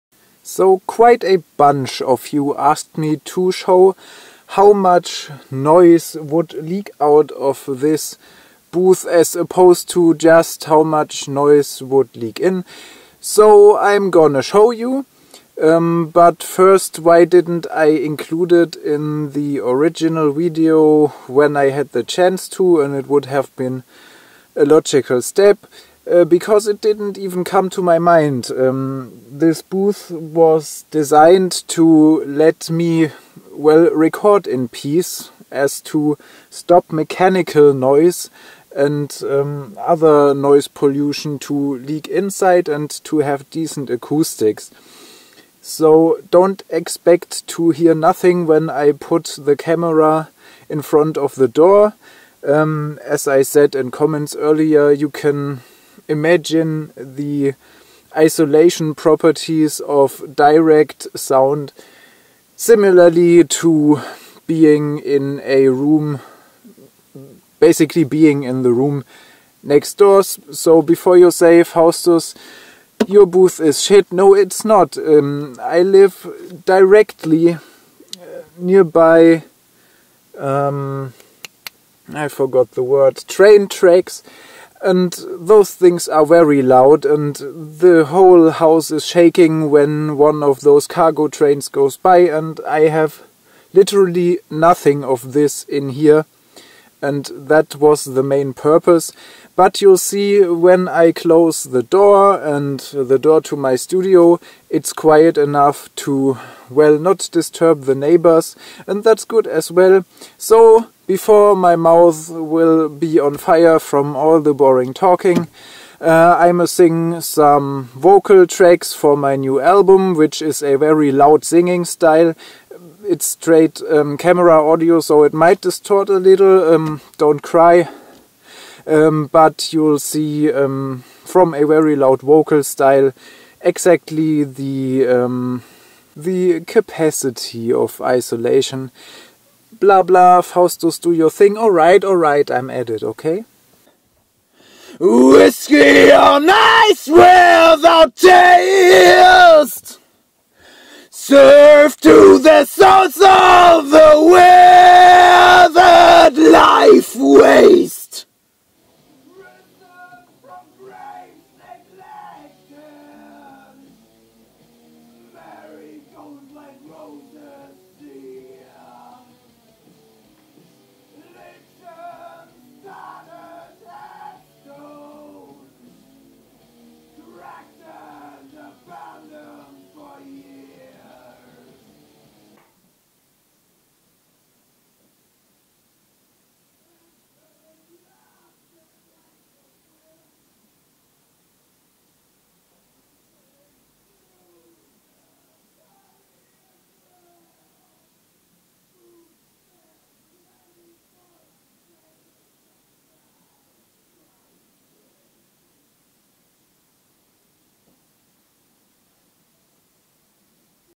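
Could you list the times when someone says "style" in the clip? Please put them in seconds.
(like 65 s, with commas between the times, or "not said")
121 s, 132 s.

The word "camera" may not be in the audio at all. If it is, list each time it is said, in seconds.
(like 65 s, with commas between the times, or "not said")
49 s, 124 s.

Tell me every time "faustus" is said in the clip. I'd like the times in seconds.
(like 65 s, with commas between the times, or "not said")
71 s, 140 s.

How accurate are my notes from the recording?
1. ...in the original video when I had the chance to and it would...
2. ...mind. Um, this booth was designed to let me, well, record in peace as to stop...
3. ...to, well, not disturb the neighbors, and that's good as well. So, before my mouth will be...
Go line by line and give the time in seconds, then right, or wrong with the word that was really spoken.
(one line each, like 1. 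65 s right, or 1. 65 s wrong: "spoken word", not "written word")
1. 18 s right
2. 27 s right
3. 105 s right.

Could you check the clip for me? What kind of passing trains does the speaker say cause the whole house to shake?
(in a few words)
cargo trains.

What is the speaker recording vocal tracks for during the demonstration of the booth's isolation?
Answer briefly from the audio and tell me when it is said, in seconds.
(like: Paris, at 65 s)
new album, at 119 s.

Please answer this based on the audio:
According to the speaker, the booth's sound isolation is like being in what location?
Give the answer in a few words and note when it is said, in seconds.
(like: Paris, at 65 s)
the room next door, at 68 s.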